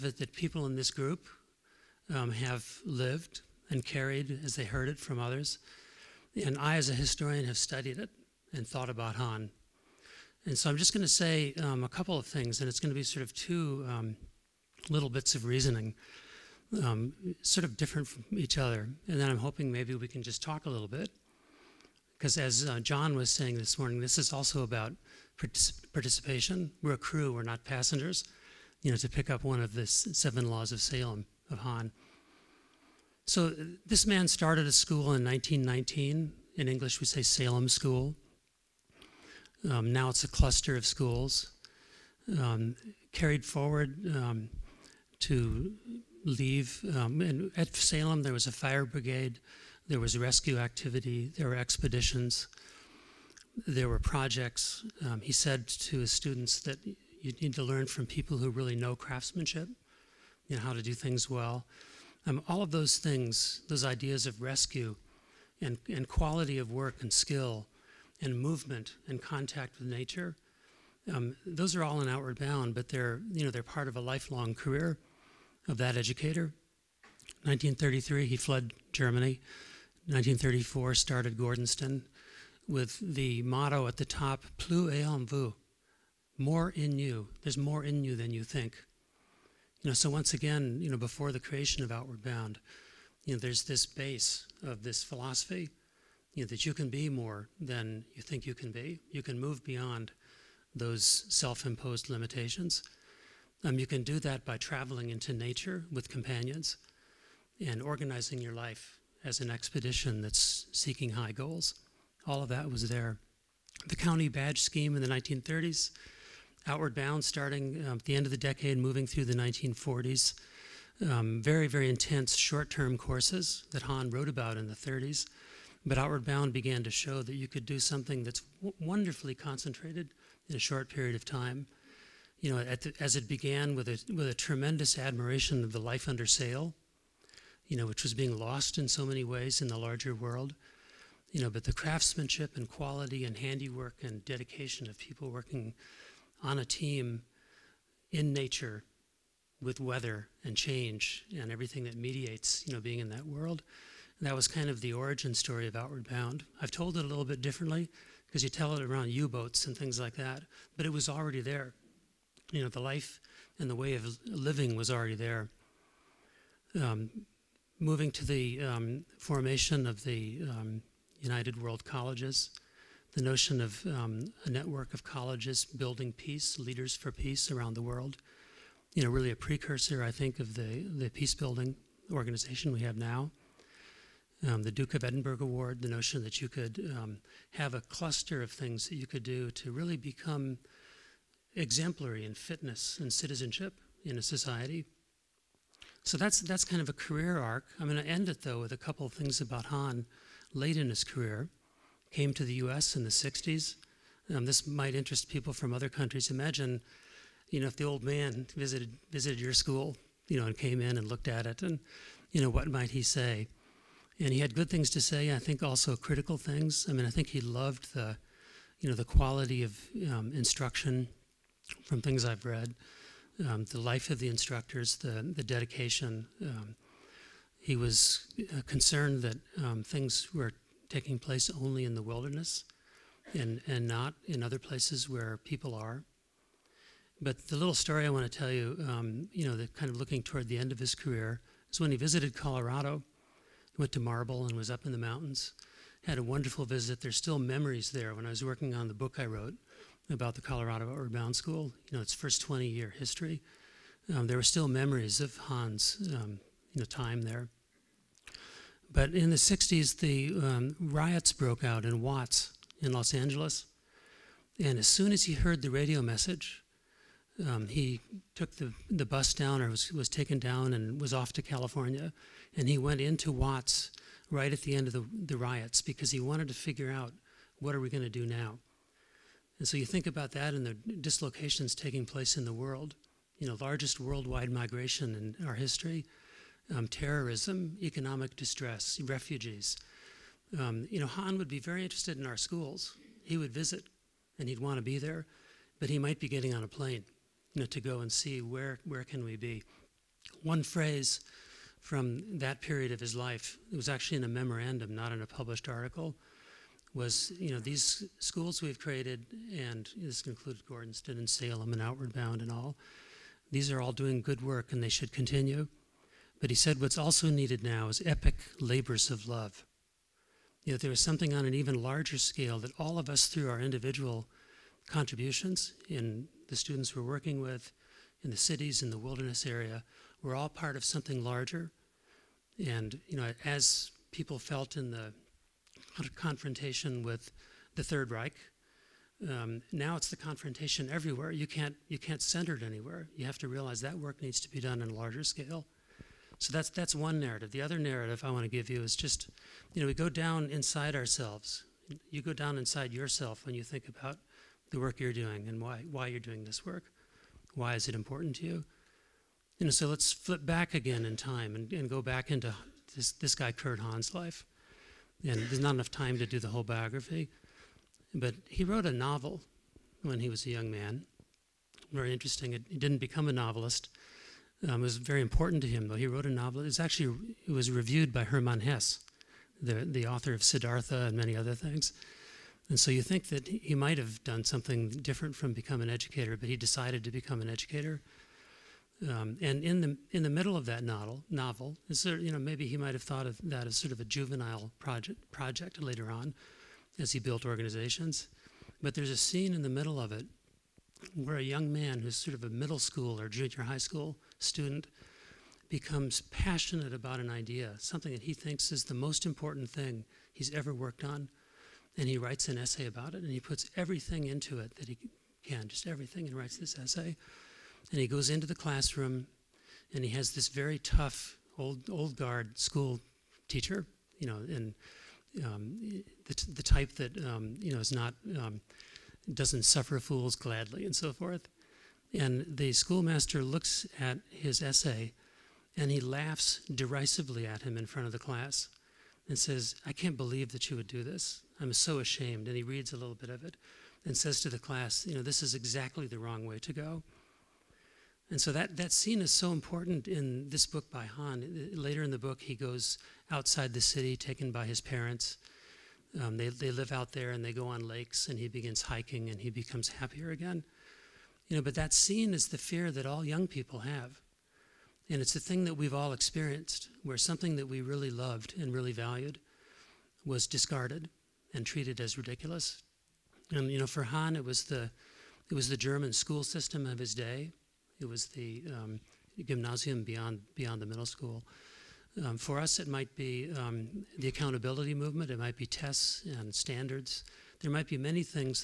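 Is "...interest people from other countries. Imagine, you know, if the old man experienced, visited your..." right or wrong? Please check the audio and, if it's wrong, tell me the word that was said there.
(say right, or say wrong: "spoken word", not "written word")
wrong: "visited", not "experienced".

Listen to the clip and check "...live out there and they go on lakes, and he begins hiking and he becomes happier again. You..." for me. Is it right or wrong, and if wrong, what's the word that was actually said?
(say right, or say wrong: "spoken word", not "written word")
right.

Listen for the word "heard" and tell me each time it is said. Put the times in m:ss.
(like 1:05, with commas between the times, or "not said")
0:04, 4:25.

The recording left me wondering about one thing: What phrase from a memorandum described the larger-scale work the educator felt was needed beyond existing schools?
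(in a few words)
Epic labors of love.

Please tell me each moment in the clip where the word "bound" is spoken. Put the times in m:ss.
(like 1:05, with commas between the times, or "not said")
1:12, 1:32, 1:56, 2:06, 2:36, 4:11, 5:12.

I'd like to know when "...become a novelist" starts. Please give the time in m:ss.
6:12.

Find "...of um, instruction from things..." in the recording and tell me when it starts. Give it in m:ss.
3:39.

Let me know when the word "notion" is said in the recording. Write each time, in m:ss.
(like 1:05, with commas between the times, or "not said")
2:53, 3:05.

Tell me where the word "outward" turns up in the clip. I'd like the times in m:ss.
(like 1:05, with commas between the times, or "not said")
1:12, 1:31, 1:56, 2:05, 2:35, 4:10, 5:11.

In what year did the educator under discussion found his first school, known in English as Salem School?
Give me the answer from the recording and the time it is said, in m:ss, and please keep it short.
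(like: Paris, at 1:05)
1919, at 0:35.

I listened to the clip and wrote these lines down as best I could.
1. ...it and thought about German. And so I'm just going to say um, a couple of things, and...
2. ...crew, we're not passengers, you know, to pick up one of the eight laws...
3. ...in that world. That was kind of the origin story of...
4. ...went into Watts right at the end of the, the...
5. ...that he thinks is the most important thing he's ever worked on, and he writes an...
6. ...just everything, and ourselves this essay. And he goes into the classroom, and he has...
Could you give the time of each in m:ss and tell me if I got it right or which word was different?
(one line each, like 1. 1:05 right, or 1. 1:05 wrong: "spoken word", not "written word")
1. 0:07 wrong: "Hahn", not "German"
2. 0:26 wrong: "seven", not "eight"
3. 2:32 right
4. 4:32 right
5. 6:48 right
6. 6:55 wrong: "writes", not "ourselves".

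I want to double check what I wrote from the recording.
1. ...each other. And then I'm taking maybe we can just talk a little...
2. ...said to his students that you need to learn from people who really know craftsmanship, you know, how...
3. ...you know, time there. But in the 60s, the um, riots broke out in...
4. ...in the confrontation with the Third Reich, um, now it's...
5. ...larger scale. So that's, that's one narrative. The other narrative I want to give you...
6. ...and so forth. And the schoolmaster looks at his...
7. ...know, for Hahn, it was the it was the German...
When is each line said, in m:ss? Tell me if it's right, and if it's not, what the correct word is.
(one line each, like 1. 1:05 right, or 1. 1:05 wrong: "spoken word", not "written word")
1. 0:18 wrong: "hoping", not "taking"
2. 0:55 right
3. 4:16 right
4. 5:34 right
5. 5:44 right
6. 7:10 right
7. 7:53 right.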